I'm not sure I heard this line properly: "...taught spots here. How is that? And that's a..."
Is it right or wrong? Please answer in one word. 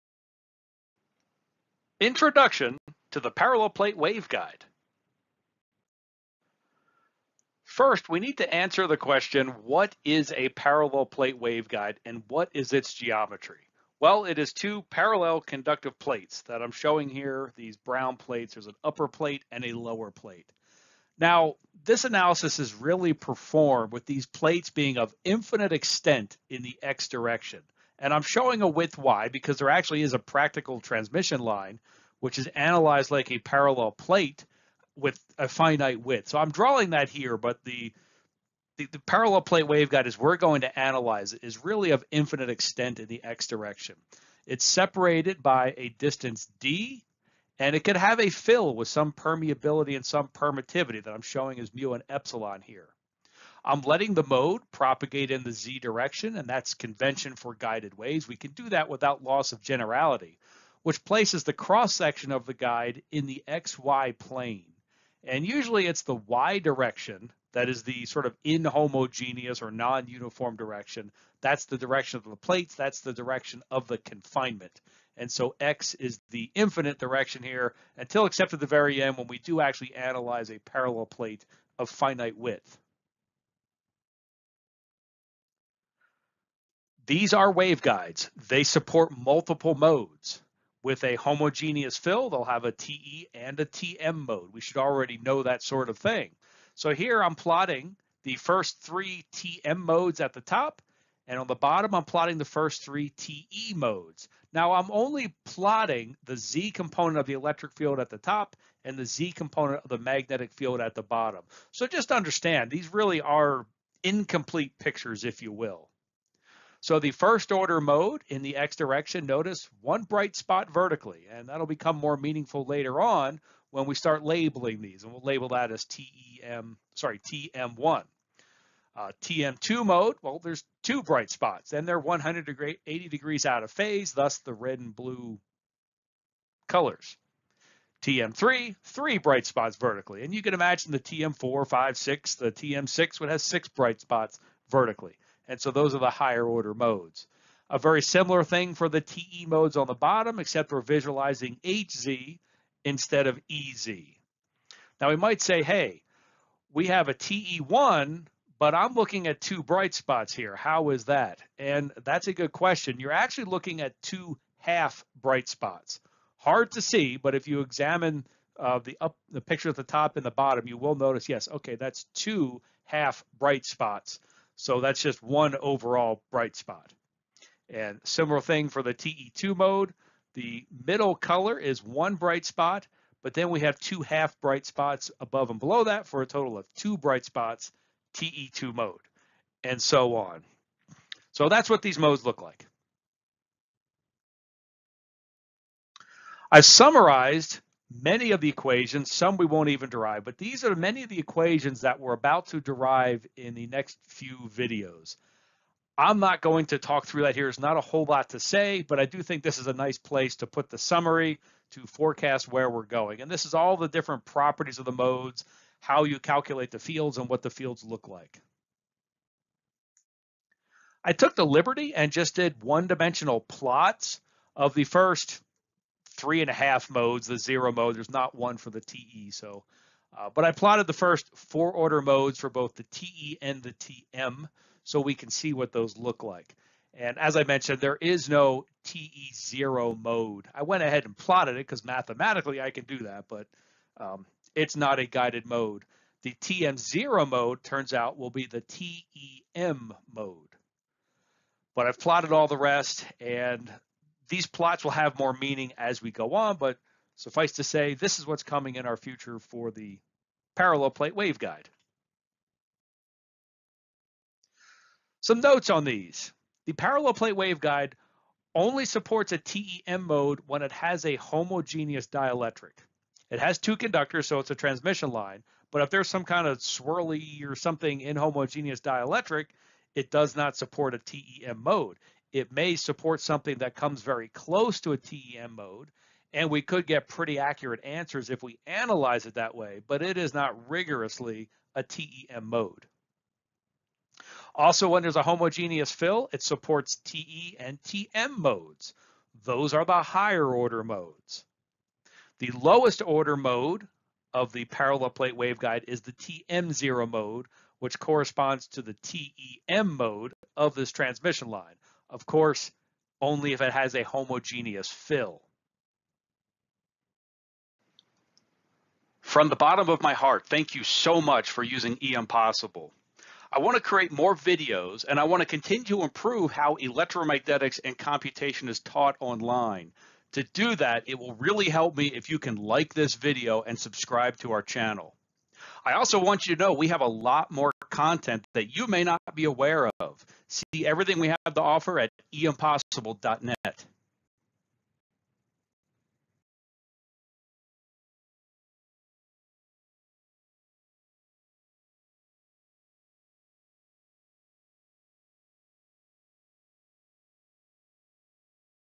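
wrong.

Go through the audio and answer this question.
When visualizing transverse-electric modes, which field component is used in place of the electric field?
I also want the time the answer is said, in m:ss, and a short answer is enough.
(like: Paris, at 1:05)
HZ, at 2:31.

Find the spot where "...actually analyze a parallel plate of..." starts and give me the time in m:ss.
1:19.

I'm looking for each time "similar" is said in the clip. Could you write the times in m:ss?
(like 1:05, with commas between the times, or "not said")
2:28, 2:58.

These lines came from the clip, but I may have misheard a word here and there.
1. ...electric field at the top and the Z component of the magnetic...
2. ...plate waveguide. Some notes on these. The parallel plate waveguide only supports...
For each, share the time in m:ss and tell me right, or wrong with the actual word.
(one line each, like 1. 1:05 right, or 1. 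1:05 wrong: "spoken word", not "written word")
1. 1:47 right
2. 4:20 right.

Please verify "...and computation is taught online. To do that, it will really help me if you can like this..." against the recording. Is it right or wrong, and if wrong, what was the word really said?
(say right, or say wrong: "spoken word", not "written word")
right.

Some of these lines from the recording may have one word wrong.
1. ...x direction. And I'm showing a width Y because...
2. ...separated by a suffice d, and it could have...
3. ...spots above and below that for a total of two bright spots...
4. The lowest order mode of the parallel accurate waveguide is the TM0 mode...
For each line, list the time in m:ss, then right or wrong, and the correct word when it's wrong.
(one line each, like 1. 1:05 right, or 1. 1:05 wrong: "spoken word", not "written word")
1. 0:26 right
2. 0:44 wrong: "distance", not "suffice"
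3. 3:04 right
4. 5:02 wrong: "plate", not "accurate".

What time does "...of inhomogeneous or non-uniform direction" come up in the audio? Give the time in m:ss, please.
1:08.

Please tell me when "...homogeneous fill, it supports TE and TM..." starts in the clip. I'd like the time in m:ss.
4:55.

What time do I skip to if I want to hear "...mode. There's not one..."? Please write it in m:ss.
3:47.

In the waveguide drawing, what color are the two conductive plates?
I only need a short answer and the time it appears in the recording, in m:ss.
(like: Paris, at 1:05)
Brown, at 0:17.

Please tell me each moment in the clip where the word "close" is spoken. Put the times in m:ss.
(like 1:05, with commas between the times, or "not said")
4:44.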